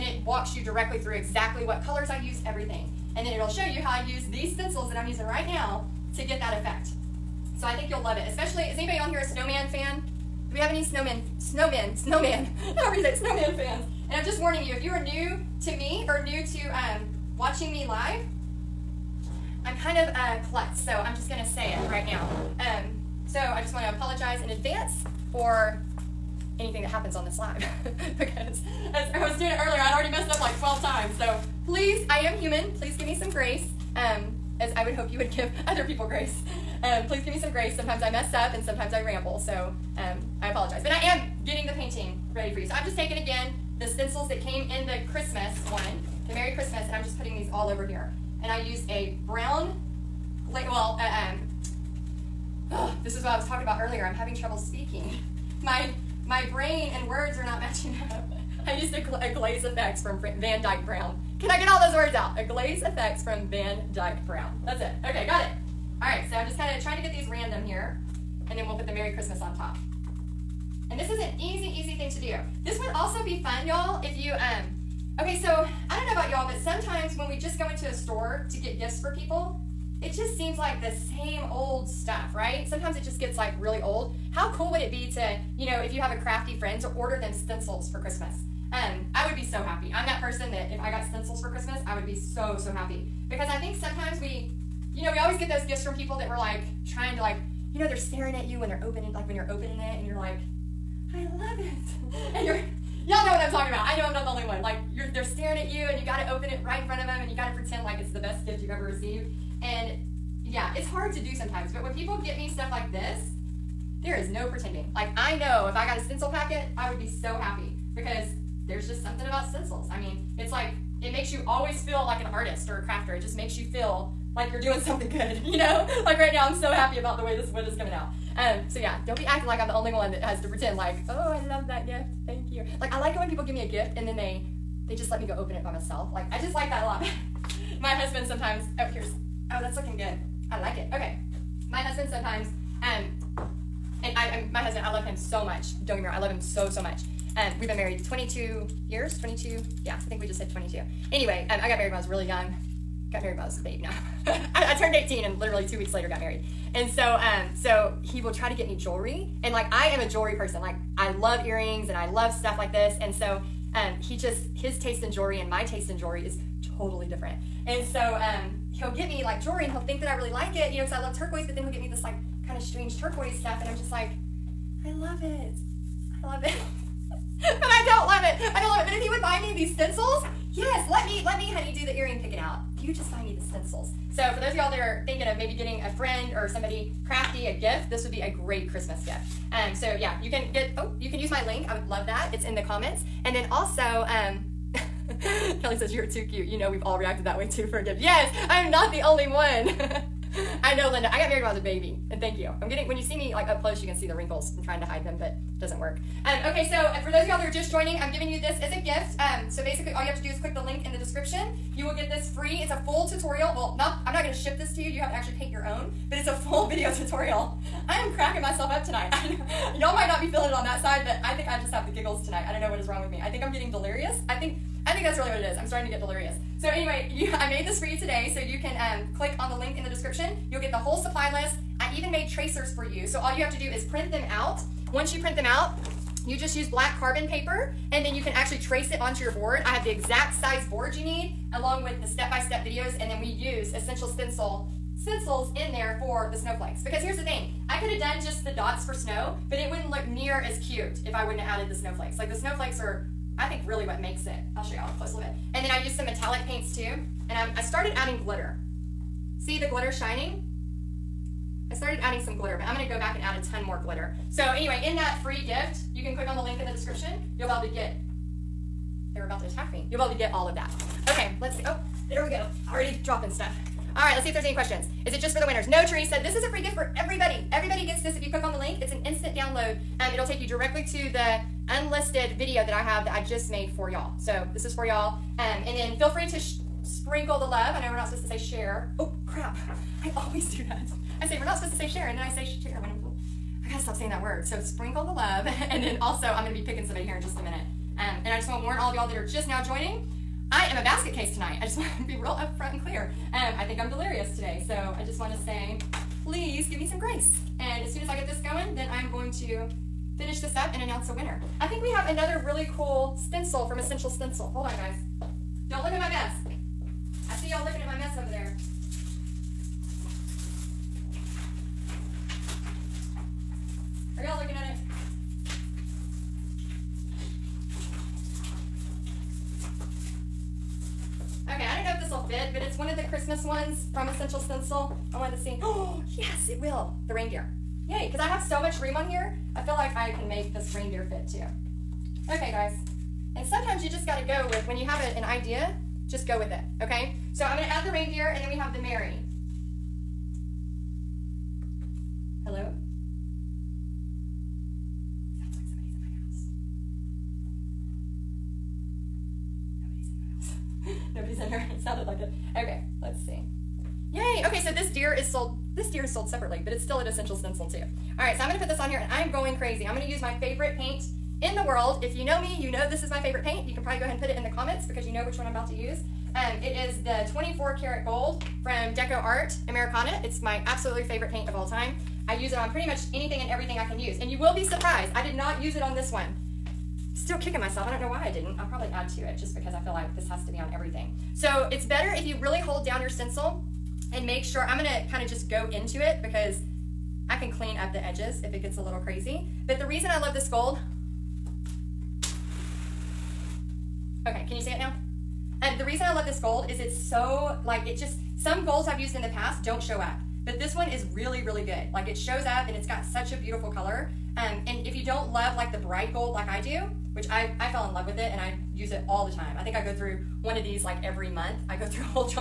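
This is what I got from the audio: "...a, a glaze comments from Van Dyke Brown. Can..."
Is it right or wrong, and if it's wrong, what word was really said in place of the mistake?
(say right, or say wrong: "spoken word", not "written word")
wrong: "effects", not "comments".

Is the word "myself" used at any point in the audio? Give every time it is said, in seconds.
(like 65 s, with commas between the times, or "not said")
135 s, 218 s, 387 s.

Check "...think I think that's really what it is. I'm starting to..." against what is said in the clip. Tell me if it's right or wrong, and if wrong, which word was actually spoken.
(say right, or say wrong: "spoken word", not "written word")
right.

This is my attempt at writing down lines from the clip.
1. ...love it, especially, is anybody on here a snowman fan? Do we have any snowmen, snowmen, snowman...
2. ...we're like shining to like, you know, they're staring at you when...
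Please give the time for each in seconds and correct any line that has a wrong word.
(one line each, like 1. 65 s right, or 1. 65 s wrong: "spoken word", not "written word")
1. 8 s right
2. 96 s wrong: "trying", not "shining".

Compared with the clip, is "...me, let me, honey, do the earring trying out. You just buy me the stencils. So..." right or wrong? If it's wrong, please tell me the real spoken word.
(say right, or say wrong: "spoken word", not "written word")
wrong: "picking", not "trying".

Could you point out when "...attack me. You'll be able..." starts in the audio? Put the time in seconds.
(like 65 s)
269 s.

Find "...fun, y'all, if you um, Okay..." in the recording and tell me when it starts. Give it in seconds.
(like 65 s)
73 s.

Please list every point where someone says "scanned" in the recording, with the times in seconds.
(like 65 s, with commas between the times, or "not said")
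not said.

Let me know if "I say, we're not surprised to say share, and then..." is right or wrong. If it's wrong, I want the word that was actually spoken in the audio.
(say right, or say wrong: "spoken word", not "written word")
wrong: "supposed", not "surprised".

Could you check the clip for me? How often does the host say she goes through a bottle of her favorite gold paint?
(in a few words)
Every month.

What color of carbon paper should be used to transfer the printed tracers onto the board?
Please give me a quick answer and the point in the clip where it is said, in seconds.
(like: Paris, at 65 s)
Black, at 236 s.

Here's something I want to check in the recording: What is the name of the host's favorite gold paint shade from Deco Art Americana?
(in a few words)
24 karat gold.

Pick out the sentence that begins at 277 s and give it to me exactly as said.
Everybody gets this if you click on the link.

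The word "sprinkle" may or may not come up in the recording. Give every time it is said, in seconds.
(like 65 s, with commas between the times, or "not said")
286 s, 294 s.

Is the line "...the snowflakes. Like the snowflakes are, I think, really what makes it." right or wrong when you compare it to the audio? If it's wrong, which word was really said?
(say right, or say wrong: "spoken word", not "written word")
right.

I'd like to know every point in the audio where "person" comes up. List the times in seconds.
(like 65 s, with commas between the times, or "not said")
90 s, 160 s.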